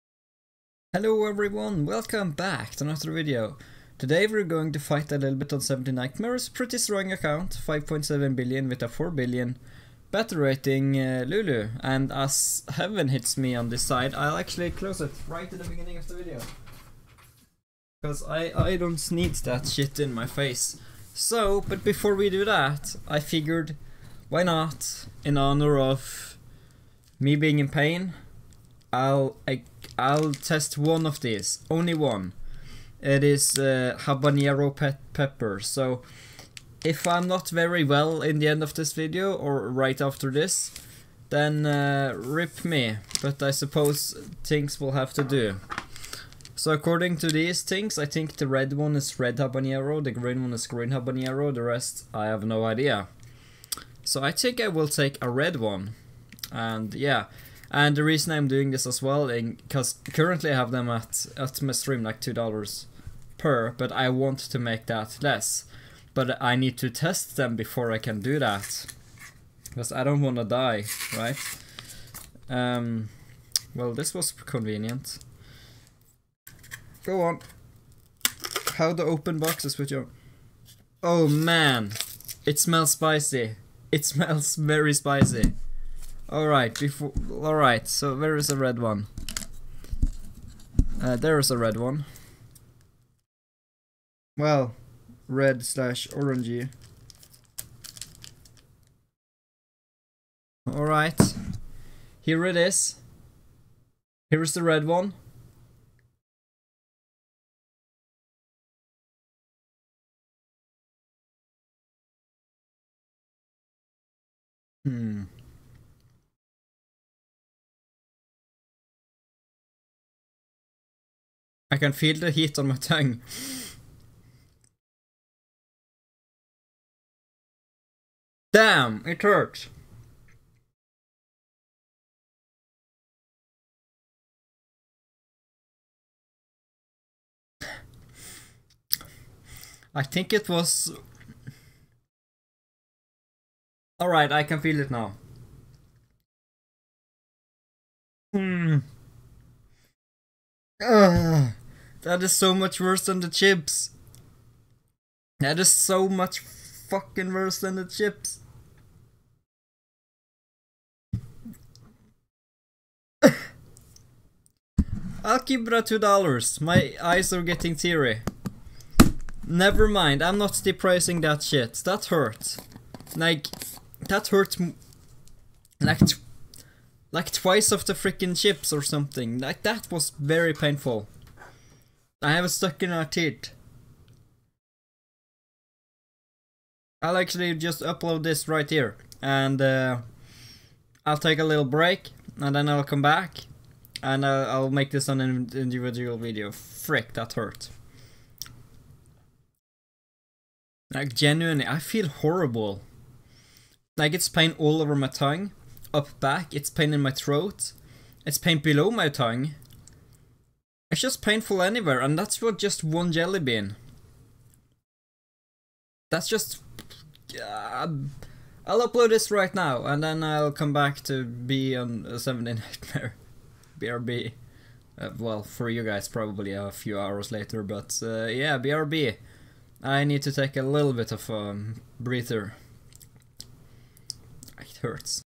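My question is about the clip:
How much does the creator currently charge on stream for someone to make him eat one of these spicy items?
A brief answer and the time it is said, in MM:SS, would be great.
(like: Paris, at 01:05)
$2, at 01:02.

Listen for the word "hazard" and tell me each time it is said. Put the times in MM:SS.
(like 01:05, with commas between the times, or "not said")
not said.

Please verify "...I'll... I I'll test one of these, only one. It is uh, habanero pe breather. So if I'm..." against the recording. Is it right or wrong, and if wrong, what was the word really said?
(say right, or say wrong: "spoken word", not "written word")
wrong: "pepper", not "breather".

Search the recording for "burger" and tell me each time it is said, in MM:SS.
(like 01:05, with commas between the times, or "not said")
not said.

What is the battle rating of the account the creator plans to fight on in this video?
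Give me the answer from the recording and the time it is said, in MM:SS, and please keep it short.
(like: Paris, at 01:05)
4 billion, at 00:08.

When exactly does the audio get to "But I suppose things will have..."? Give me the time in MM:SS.
00:43.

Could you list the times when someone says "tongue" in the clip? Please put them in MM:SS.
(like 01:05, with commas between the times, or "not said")
02:02, 03:25, 03:29.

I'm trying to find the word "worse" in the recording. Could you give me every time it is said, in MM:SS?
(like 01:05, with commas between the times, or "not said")
02:32, 02:37.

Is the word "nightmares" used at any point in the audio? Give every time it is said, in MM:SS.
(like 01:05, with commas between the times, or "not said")
00:05, 03:42.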